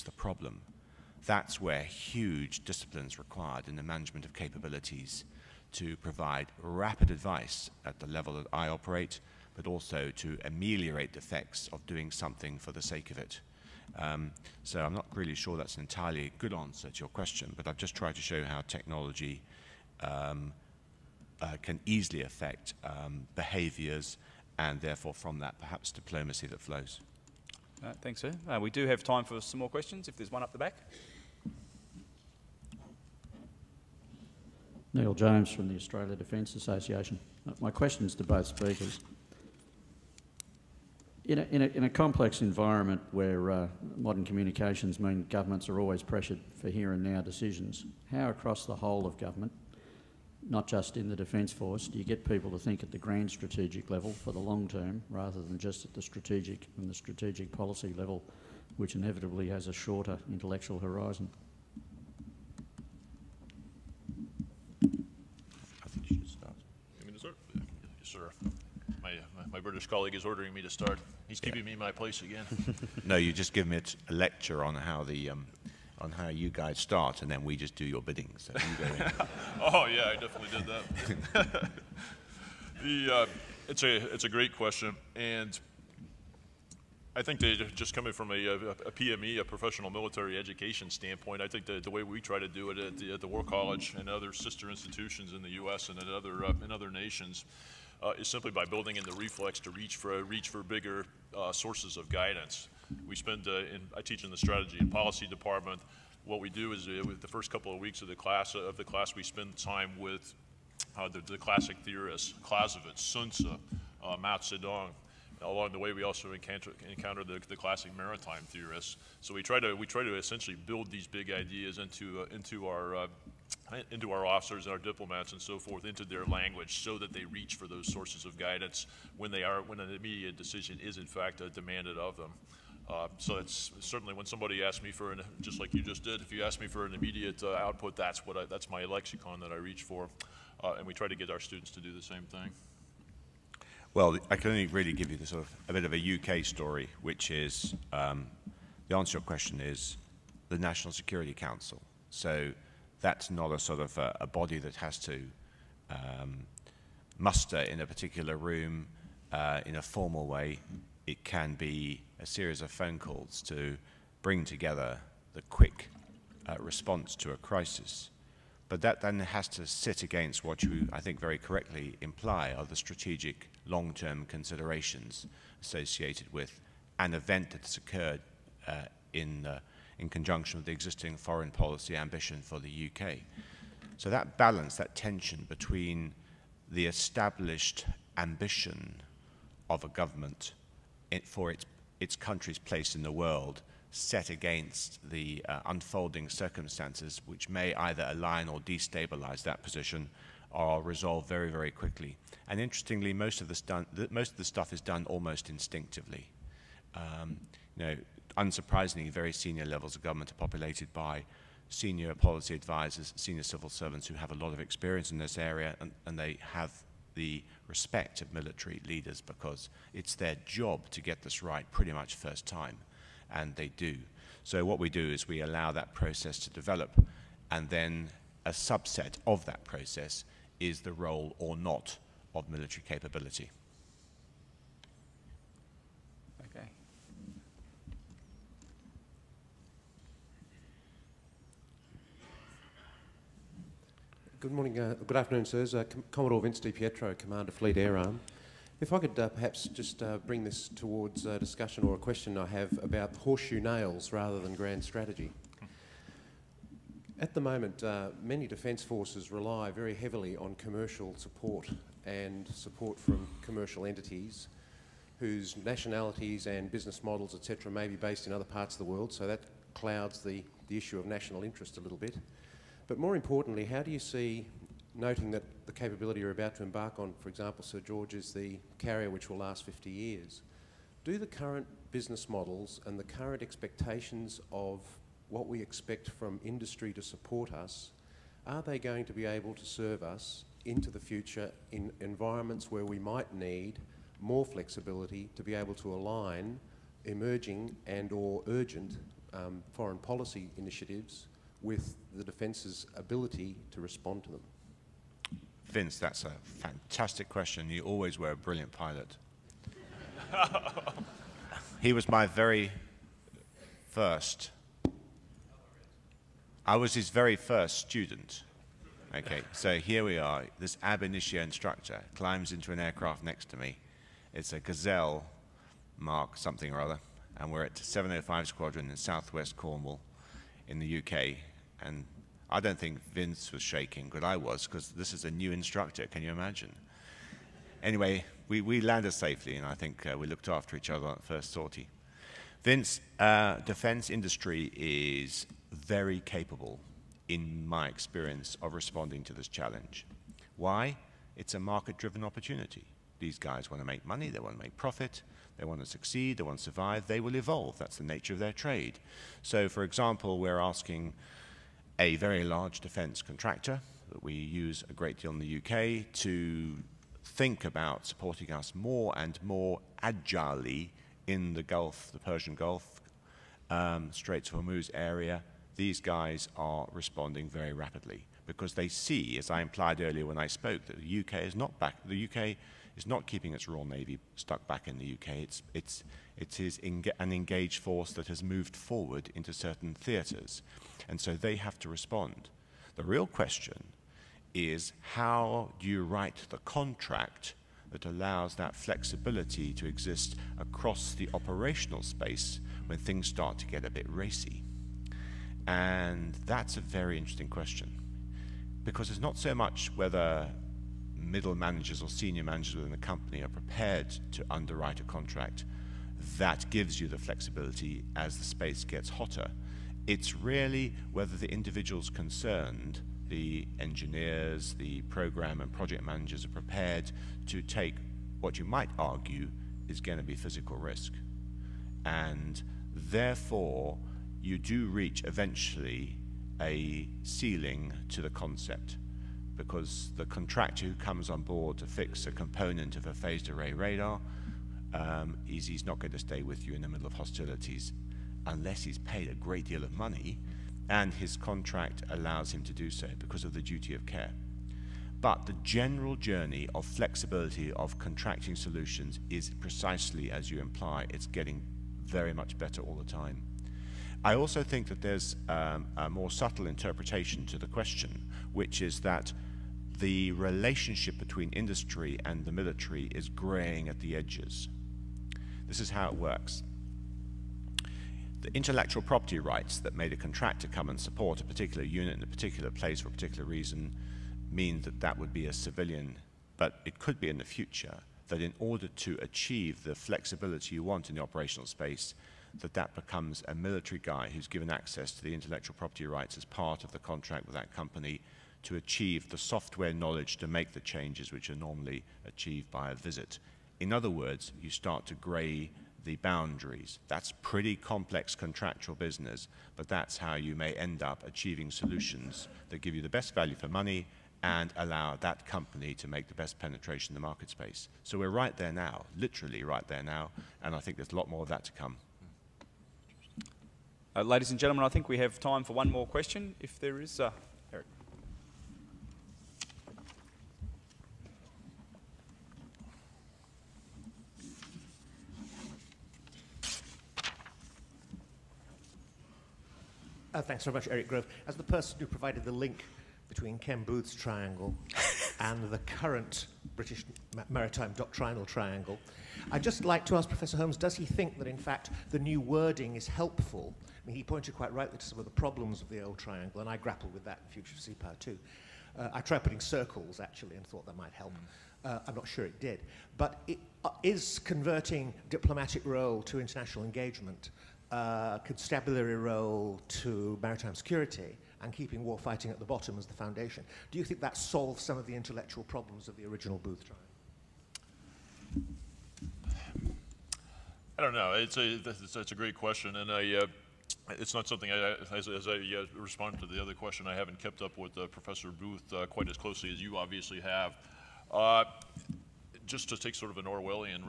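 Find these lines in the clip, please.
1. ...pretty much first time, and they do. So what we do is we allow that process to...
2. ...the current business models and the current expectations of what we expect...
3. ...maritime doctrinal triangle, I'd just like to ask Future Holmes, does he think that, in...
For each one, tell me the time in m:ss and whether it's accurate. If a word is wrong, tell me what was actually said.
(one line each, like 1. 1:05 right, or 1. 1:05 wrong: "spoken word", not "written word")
1. 3:41 right
2. 4:41 right
3. 9:07 wrong: "Professor", not "Future".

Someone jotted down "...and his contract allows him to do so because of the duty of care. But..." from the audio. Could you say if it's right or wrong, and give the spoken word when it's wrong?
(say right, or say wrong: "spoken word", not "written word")
right.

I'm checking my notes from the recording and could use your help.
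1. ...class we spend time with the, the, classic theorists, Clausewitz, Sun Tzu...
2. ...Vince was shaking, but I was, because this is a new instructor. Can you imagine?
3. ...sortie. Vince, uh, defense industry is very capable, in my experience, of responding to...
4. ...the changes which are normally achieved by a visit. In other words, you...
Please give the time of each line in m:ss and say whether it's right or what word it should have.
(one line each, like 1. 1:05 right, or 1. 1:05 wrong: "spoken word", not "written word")
1. 1:48 right
2. 5:33 right
3. 5:41 right
4. 8:20 right.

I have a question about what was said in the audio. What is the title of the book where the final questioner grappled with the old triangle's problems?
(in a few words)
Future of Sea Power.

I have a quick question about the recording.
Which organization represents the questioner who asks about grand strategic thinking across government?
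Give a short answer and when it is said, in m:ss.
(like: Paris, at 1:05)
Australia Defence Association, at 0:35.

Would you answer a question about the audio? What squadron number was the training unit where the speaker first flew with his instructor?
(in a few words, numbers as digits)
705.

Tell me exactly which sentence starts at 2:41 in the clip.
It can be a series of phone calls to bring together the quick uh, response to a crisis.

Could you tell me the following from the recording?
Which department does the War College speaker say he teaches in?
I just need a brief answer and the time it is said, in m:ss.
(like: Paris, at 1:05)
Strategy and policy, at 1:44.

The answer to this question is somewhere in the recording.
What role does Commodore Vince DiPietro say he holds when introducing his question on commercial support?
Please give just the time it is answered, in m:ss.
4:07.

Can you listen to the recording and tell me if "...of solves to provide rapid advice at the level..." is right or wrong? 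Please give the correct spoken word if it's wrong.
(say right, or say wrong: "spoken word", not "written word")
wrong: "capabilities", not "solves".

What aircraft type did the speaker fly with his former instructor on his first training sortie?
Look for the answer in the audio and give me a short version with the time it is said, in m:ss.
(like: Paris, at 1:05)
Gazelle, at 5:24.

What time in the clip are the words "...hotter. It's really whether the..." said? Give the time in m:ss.
6:59.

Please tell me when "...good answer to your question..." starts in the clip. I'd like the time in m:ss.
0:16.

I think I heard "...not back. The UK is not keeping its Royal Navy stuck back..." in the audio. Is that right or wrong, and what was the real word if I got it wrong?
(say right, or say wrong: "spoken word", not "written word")
right.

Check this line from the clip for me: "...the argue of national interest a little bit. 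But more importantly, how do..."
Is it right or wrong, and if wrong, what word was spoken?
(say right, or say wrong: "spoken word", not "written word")
wrong: "issue", not "argue".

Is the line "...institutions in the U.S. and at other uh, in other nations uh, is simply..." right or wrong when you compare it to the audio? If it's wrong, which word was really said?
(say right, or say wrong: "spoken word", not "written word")
right.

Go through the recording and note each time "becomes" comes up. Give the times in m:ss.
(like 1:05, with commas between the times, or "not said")
8:12.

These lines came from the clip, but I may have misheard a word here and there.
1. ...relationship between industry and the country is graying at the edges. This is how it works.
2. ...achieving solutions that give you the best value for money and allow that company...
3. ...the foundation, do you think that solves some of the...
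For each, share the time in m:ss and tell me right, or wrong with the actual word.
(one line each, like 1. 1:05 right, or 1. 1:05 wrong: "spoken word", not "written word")
1. 7:50 wrong: "military", not "country"
2. 8:31 right
3. 9:33 right.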